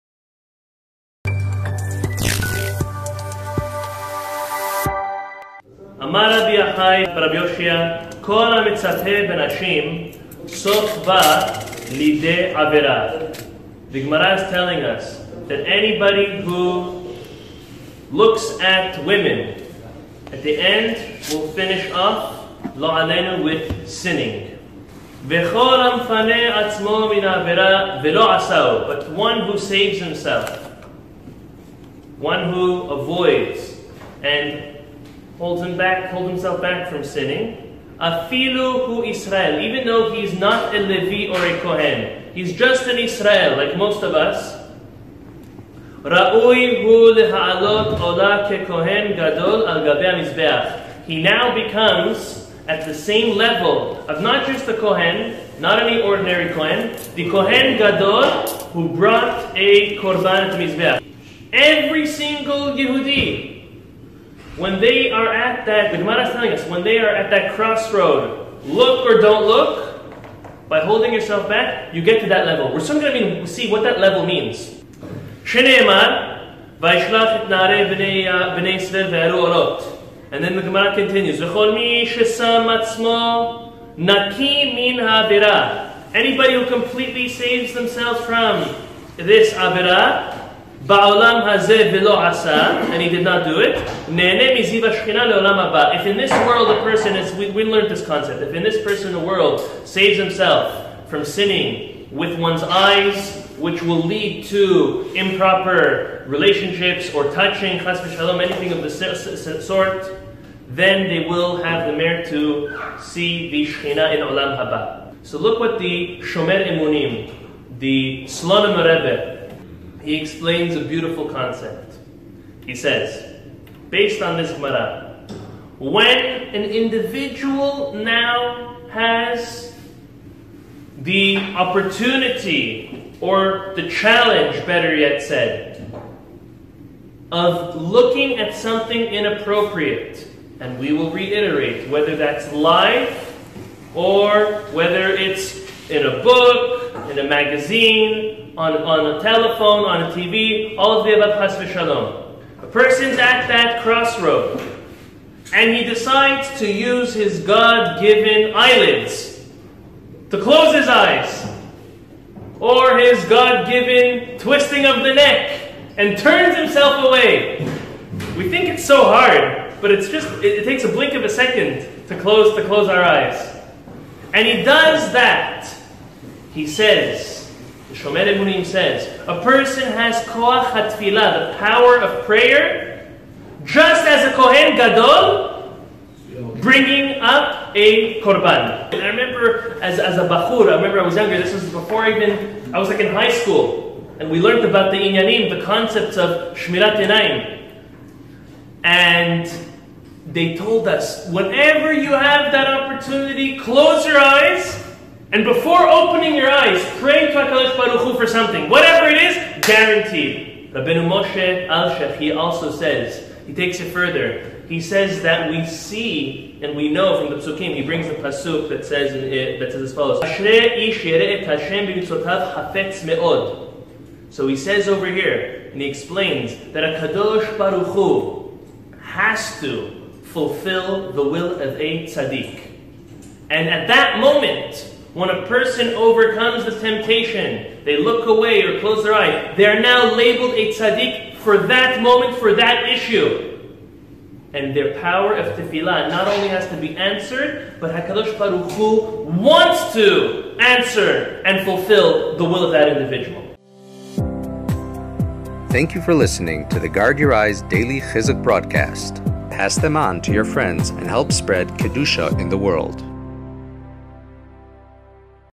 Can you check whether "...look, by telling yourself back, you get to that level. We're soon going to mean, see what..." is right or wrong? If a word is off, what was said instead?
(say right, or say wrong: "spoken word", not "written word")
wrong: "holding", not "telling".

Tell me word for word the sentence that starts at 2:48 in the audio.
We think it's so hard, but it's just, it, it takes a blink of a second to close, to close our eyes.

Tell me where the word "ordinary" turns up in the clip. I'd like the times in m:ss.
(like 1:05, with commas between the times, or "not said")
0:56.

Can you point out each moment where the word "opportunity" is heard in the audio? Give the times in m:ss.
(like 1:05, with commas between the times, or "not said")
2:11, 3:22.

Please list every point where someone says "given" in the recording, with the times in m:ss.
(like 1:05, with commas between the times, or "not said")
2:37, 2:43.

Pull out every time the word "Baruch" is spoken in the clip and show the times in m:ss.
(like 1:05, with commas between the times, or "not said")
3:27, 3:47, 4:08.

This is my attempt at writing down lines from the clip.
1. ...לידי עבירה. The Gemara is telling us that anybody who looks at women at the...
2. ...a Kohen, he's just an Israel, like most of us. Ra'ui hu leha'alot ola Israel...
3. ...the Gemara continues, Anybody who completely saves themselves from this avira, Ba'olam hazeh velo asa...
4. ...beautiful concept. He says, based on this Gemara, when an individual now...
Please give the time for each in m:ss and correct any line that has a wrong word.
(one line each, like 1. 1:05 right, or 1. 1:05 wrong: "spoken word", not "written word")
1. 0:11 right
2. 0:41 wrong: "Kohen", not "Israel"
3. 1:20 right
4. 2:00 right.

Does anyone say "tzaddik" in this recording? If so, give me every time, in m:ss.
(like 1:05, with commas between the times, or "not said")
3:52, 4:00.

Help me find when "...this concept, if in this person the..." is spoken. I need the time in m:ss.
1:37.